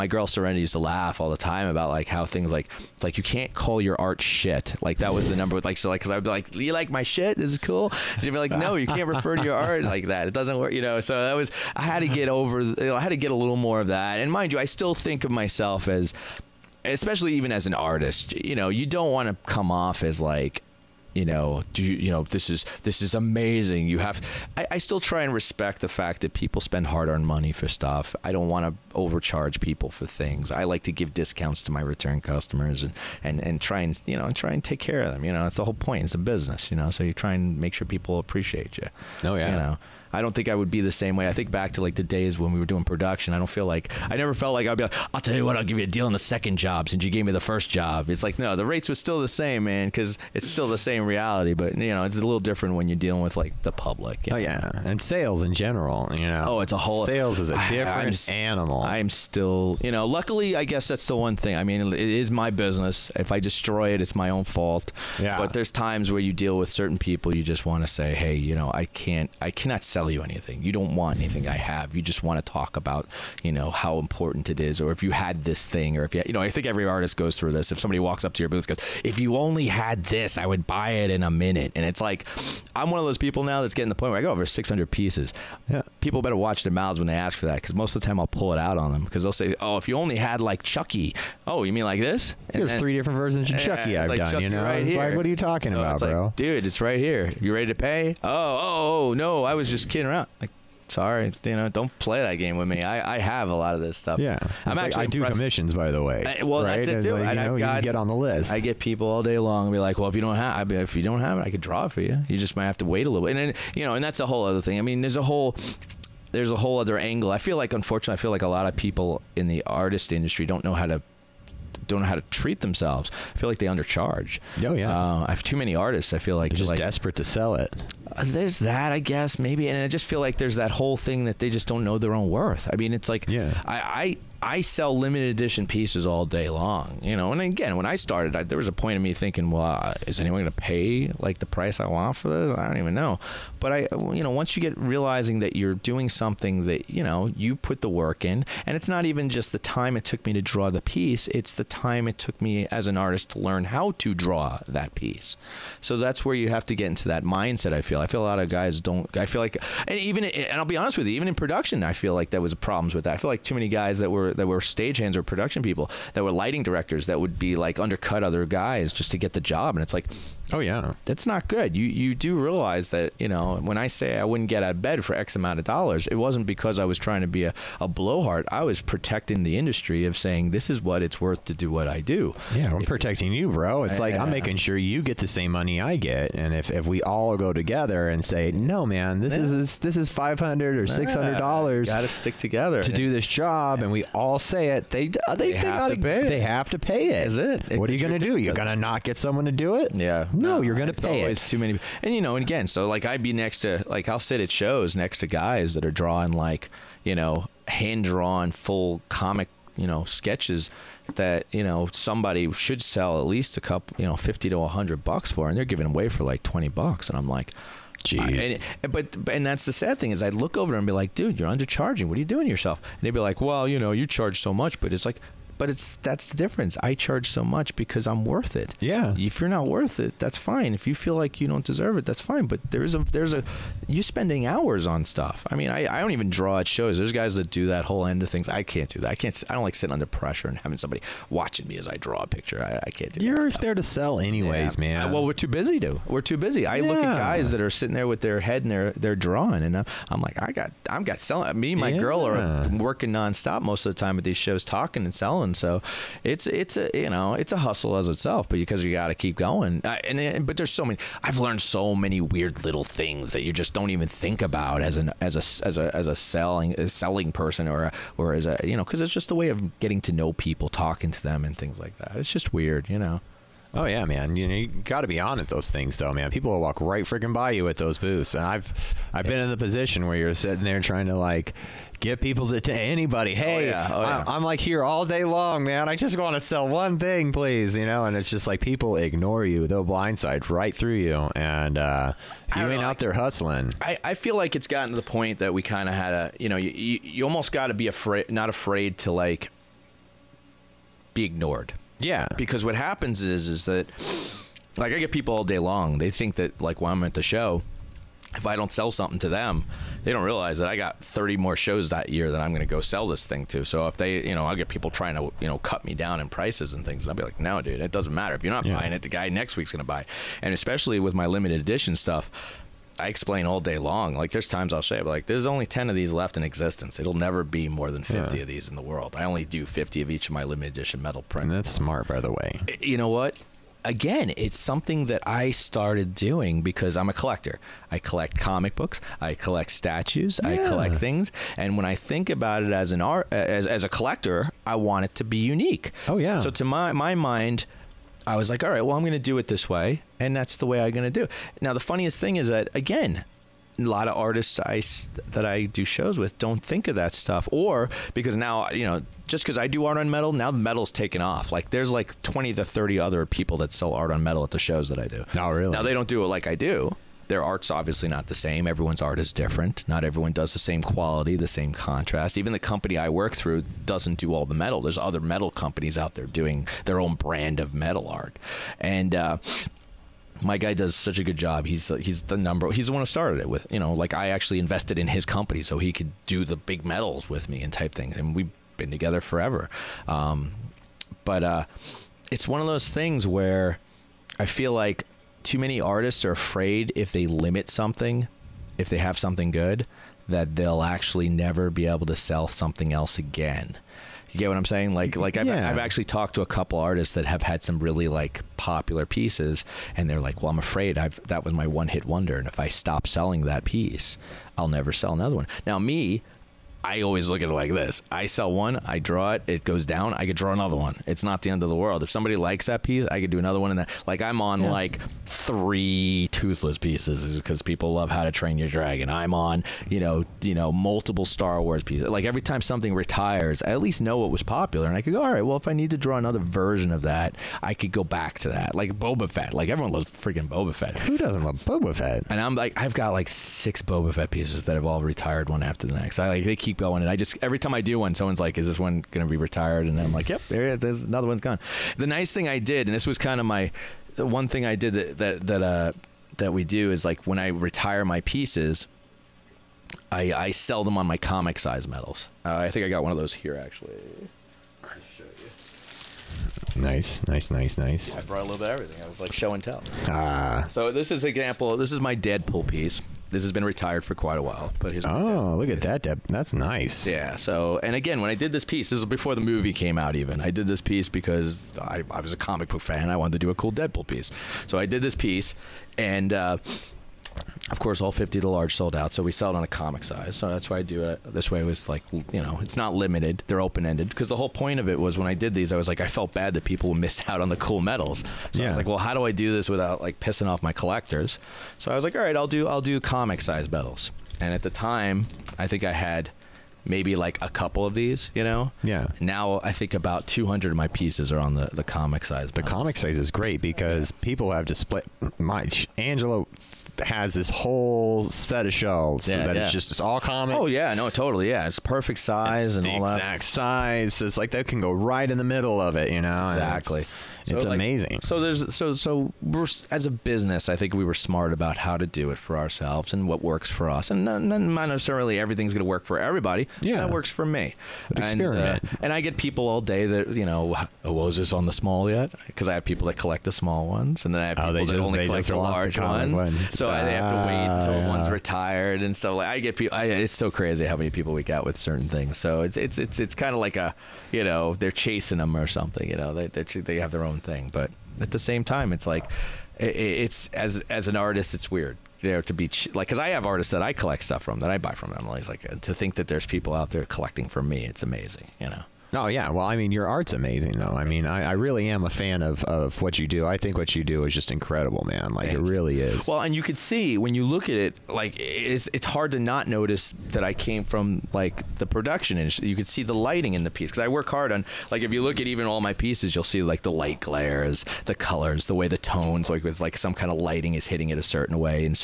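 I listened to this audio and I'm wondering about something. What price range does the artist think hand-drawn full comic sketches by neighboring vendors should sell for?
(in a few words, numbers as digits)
50 to 100 bucks.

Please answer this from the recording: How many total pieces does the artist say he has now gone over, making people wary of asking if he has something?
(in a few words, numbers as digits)
600.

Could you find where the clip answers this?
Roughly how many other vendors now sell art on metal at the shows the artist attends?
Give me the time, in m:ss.
6:02.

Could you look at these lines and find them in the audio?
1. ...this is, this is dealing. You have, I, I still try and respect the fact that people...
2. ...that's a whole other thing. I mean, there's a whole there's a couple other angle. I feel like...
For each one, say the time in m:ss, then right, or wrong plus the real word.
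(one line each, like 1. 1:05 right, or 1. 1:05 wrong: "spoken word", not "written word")
1. 0:22 wrong: "amazing", not "dealing"
2. 1:54 wrong: "whole", not "couple".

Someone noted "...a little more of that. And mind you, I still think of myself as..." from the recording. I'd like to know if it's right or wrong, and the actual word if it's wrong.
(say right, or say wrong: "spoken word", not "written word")
right.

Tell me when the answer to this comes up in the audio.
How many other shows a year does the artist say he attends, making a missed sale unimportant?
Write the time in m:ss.
5:11.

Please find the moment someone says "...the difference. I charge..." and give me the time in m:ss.
3:46.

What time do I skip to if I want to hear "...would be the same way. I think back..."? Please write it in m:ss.
0:40.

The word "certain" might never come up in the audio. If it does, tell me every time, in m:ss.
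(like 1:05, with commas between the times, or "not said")
1:06, 9:11, 9:51.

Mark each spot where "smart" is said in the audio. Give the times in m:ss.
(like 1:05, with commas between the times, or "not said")
5:31, 8:51.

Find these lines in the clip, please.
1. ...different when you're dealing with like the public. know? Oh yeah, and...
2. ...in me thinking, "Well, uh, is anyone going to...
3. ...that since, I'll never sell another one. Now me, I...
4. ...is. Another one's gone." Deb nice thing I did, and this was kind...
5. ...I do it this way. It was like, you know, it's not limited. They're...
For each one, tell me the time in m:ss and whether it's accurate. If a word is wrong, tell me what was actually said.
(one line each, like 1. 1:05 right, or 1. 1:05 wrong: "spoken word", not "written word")
1. 0:52 right
2. 2:18 right
3. 6:53 wrong: "piece", not "since"
4. 7:30 wrong: "The", not "Deb"
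5. 8:10 right.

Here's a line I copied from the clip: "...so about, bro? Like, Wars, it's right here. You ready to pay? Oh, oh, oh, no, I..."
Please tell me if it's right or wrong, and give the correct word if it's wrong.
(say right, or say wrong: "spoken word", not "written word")
wrong: "Dude", not "Wars".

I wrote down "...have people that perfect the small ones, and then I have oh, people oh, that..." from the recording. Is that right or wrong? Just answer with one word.
wrong.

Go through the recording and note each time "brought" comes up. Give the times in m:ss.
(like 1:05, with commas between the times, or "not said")
7:48.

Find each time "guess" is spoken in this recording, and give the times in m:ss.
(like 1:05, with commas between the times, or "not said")
1:00, 2:08.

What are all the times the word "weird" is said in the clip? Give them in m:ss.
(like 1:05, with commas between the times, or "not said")
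4:22, 4:32, 9:21.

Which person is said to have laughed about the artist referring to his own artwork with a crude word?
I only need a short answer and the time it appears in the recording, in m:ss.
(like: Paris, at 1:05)
Serenity, at 0:00.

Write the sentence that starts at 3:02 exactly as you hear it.
Yeah, I'm if, protecting you, bro.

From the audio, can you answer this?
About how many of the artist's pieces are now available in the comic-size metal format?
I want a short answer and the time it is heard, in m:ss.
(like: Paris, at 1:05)
200, at 8:30.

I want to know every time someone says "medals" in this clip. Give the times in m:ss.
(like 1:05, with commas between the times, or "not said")
6:26, 7:41, 8:17, 8:23.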